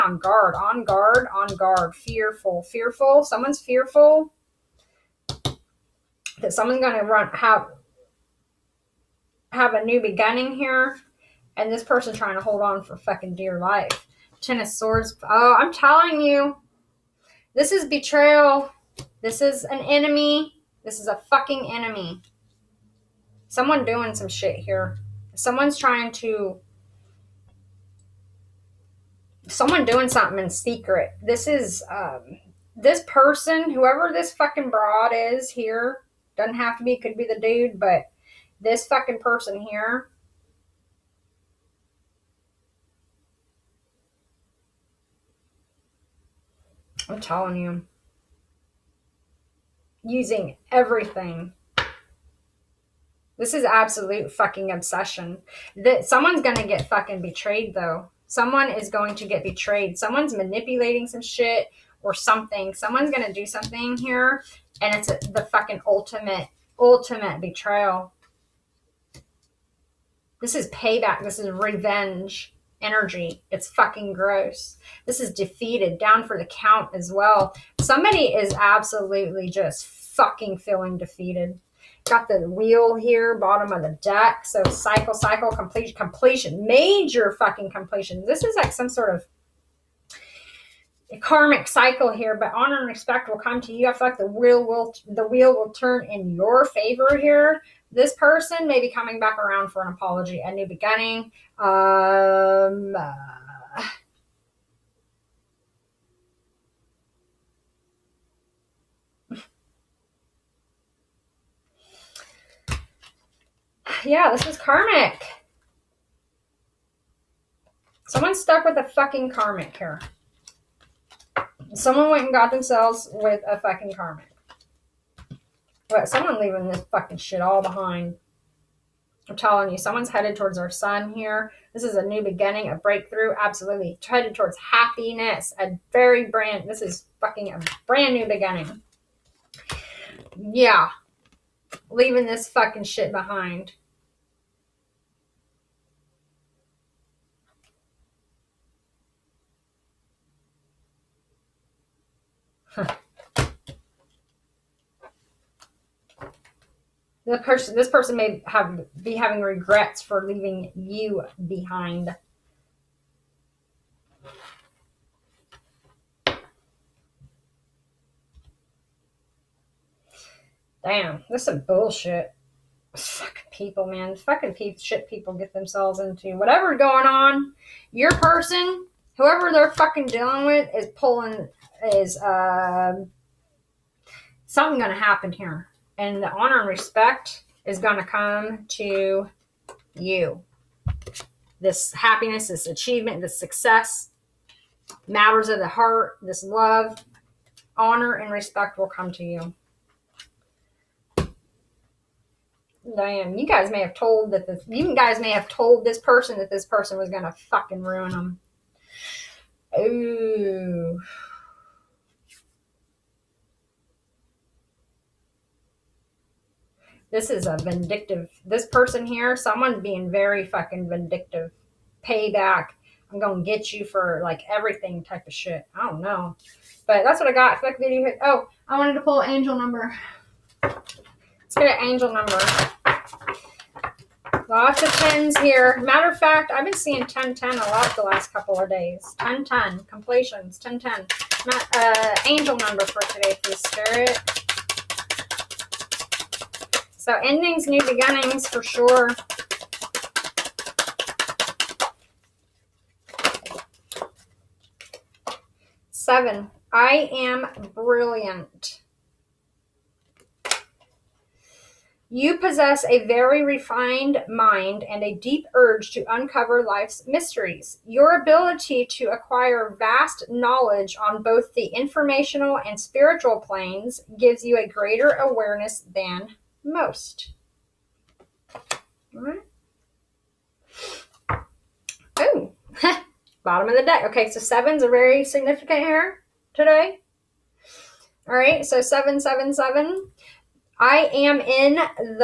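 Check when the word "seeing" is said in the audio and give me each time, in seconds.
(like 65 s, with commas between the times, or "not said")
236 s.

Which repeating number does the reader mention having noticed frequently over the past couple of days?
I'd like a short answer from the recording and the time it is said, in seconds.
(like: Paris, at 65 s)
10 10, at 237 s.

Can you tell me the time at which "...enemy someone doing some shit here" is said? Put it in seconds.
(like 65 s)
21 s.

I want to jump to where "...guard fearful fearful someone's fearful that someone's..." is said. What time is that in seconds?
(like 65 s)
1 s.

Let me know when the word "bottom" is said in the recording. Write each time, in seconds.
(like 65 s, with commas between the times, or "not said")
83 s, 283 s.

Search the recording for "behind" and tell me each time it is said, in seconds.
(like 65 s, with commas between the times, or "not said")
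127 s, 143 s, 161 s.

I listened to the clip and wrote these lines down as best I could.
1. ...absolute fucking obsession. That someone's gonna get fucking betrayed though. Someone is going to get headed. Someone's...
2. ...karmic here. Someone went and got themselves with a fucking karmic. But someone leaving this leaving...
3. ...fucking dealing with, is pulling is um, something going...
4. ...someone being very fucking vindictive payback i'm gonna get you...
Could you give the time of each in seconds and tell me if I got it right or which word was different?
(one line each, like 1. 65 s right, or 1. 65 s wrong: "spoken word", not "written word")
1. 53 s wrong: "betrayed", not "headed"
2. 119 s wrong: "fucking", not "leaving"
3. 179 s right
4. 219 s right.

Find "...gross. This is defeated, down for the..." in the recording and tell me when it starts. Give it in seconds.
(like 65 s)
74 s.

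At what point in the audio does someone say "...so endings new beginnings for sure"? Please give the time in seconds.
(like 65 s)
247 s.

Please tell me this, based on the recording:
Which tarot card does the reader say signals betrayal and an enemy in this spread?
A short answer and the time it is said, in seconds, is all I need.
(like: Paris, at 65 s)
Ten of Swords, at 14 s.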